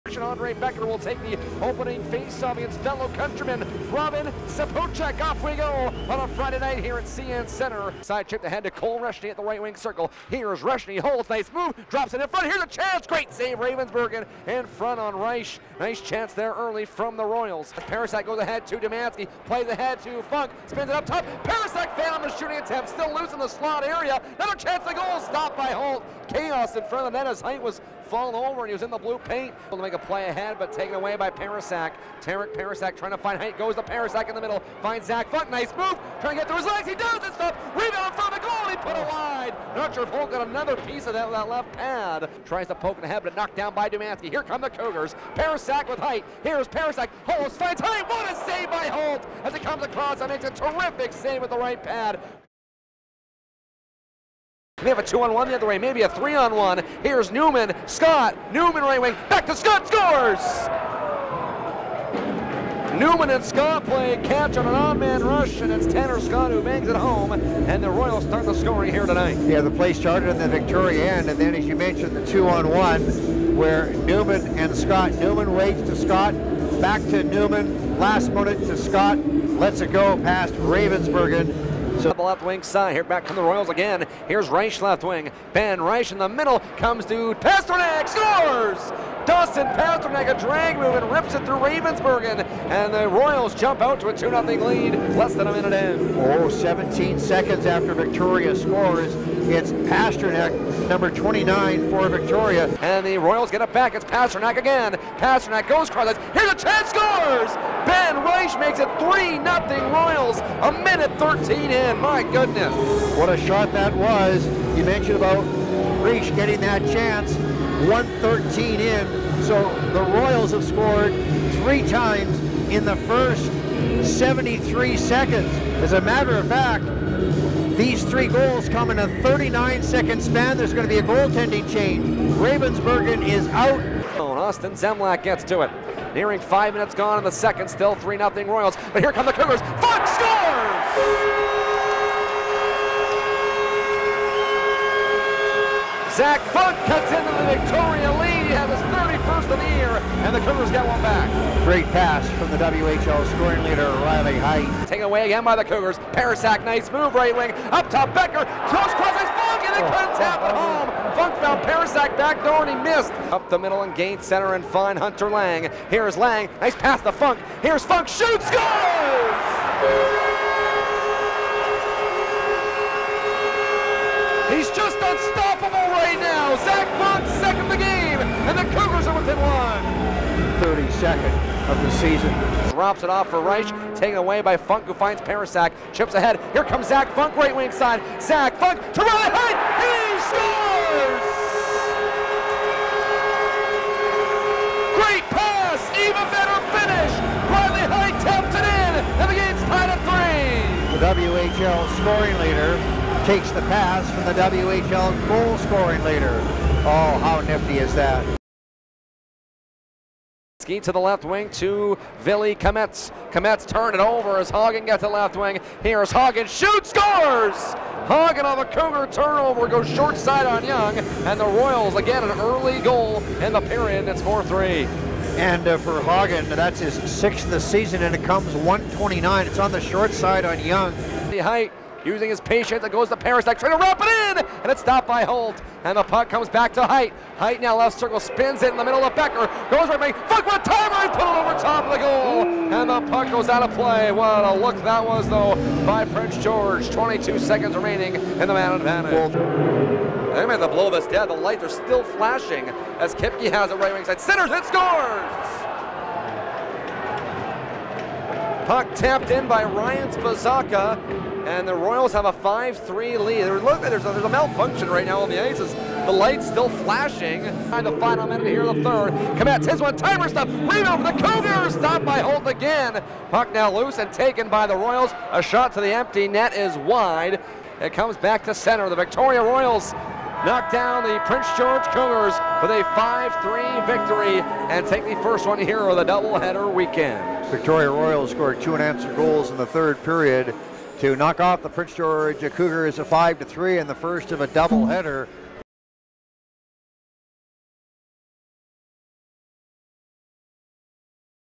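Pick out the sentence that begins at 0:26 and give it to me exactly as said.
Chaos in front of the net as Heidt was fall over and he was in the blue paint.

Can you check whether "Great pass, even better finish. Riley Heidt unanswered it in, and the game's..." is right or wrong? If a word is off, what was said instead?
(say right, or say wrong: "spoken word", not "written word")
wrong: "tapped", not "unanswered".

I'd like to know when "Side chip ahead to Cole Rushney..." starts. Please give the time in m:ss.
0:08.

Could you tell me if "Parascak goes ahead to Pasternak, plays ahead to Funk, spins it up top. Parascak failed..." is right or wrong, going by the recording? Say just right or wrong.
wrong.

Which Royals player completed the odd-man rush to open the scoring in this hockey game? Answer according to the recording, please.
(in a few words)
Tanner Scott.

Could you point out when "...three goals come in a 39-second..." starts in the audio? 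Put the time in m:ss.
2:08.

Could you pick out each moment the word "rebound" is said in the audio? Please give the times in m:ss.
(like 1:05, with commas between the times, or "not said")
0:37, 4:30.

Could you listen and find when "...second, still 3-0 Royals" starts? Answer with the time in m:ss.
2:17.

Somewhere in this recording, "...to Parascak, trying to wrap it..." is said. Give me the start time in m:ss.
3:53.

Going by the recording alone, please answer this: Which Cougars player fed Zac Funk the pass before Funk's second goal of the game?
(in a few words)
Hunter Laing.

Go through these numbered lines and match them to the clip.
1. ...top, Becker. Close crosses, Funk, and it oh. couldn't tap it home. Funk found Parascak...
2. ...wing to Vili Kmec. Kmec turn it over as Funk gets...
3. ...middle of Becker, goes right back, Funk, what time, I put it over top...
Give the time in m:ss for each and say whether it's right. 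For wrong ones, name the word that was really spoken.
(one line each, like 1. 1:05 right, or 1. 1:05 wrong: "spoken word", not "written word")
1. 2:37 right
2. 3:31 wrong: "Haugen", not "Funk"
3. 3:58 right.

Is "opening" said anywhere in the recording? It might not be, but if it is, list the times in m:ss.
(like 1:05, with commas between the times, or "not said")
0:01.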